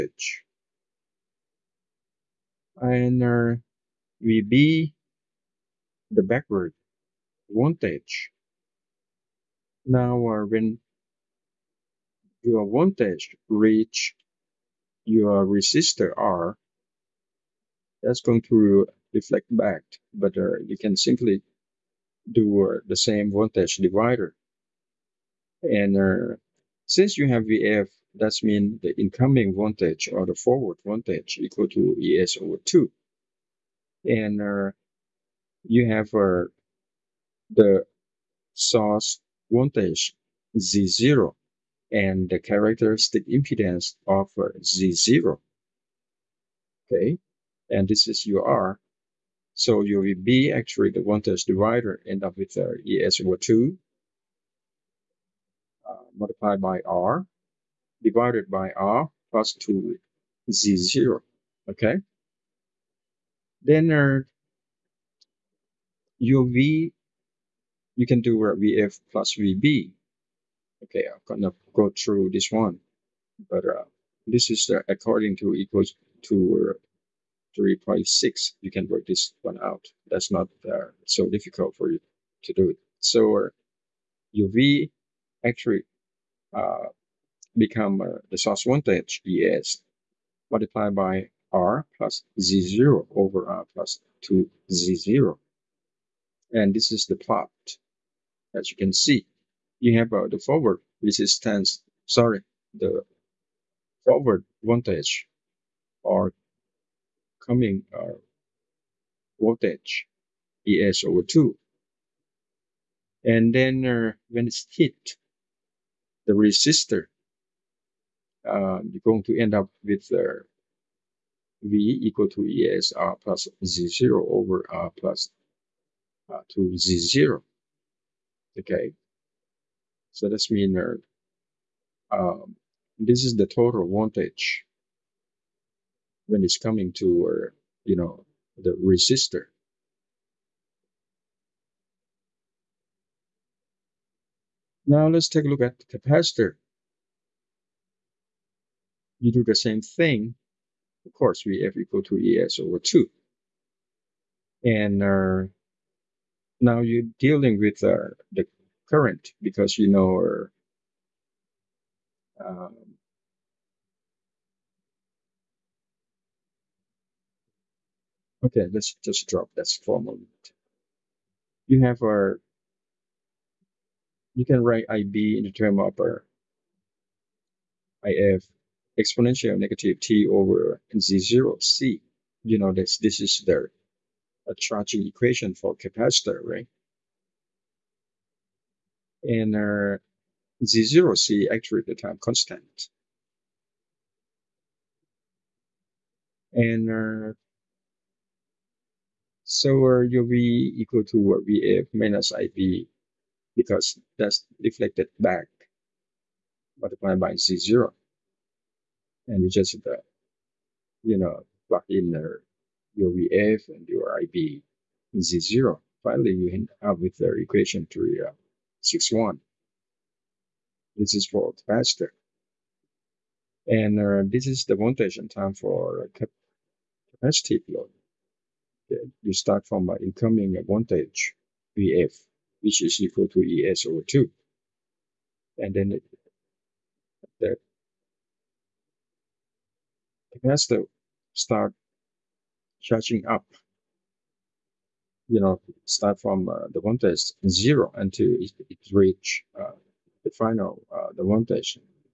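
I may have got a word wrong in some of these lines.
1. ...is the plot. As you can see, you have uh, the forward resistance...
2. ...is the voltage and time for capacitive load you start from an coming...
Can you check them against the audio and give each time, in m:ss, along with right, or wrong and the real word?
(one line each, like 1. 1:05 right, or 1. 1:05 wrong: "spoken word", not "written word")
1. 1:36 right
2. 3:44 wrong: "incoming", not "coming".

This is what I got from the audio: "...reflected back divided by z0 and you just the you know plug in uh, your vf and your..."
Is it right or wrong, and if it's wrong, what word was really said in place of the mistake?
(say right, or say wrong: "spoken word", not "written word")
wrong: "multiplied", not "divided".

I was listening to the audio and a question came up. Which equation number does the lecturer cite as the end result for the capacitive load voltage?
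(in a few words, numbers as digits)
3.61.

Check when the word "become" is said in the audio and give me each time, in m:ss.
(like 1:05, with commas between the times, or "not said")
1:27.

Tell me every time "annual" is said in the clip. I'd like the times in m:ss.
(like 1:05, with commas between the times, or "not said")
not said.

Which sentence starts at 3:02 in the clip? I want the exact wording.
You know this, this is the a charging equation for capacitor, right?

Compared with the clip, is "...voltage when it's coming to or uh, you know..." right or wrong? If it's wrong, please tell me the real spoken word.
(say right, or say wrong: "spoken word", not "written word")
right.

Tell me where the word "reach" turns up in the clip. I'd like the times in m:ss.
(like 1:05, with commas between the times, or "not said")
0:13, 4:08.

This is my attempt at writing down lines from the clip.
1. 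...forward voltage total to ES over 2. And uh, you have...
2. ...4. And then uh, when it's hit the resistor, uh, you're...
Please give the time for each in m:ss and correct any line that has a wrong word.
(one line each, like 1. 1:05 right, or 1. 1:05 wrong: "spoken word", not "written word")
1. 0:30 wrong: "equal", not "total"
2. 1:51 wrong: "2", not "4".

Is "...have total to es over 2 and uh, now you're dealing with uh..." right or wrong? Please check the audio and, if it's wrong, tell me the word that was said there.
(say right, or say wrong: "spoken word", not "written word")
wrong: "equal", not "total".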